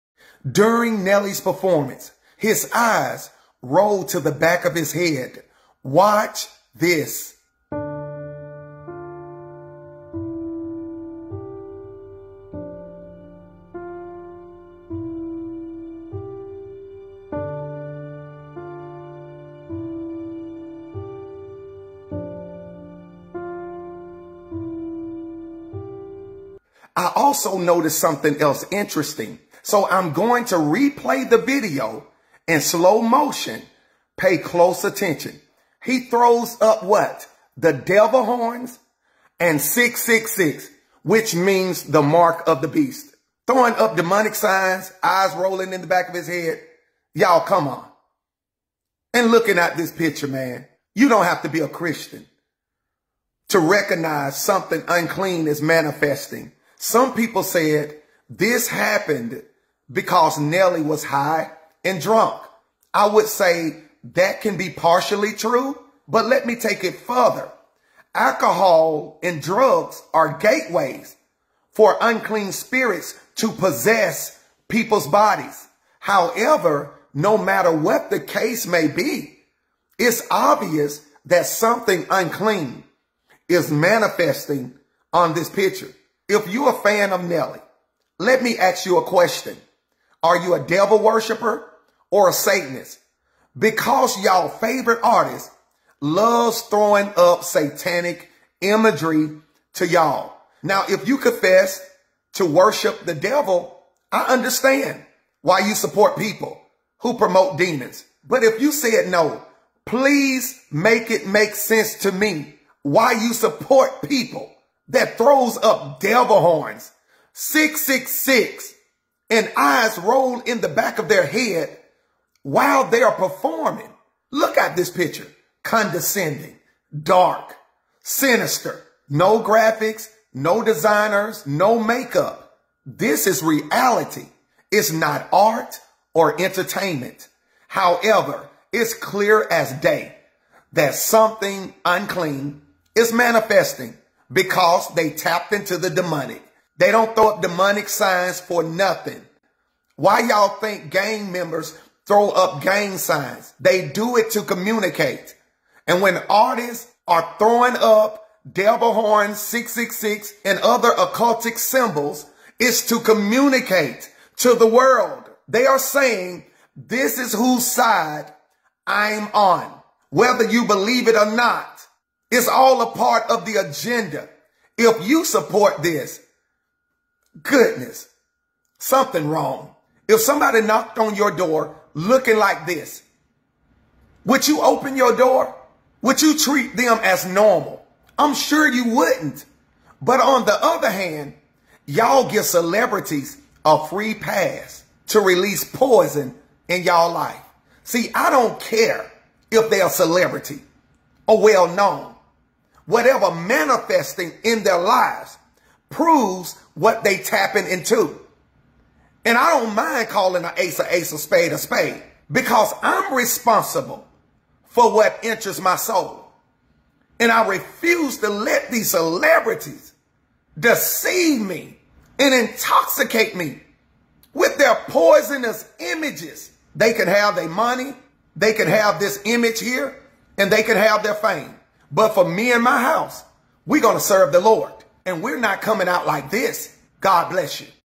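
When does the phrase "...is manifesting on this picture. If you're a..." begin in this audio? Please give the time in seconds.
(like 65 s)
83 s.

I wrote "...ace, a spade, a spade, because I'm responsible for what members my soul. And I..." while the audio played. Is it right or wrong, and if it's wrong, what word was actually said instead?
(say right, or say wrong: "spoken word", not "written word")
wrong: "enters", not "members".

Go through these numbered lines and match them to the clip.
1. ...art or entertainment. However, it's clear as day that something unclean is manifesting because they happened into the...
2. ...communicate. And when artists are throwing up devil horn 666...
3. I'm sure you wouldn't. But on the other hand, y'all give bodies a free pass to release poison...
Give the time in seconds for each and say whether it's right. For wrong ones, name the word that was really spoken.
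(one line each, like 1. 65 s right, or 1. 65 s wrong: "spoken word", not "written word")
1. 135 s wrong: "tapped", not "happened"
2. 154 s right
3. 188 s wrong: "celebrities", not "bodies".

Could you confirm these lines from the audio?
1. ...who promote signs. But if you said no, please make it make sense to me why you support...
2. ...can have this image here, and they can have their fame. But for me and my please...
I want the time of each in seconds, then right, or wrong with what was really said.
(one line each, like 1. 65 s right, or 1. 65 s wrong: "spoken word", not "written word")
1. 106 s wrong: "demons", not "signs"
2. 228 s wrong: "house", not "please".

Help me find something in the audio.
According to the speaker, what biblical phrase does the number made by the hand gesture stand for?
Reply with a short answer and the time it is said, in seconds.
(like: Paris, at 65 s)
the mark of the beast, at 41 s.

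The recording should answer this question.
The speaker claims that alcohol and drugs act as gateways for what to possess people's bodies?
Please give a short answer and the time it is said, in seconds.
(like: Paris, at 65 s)
unclean spirits, at 72 s.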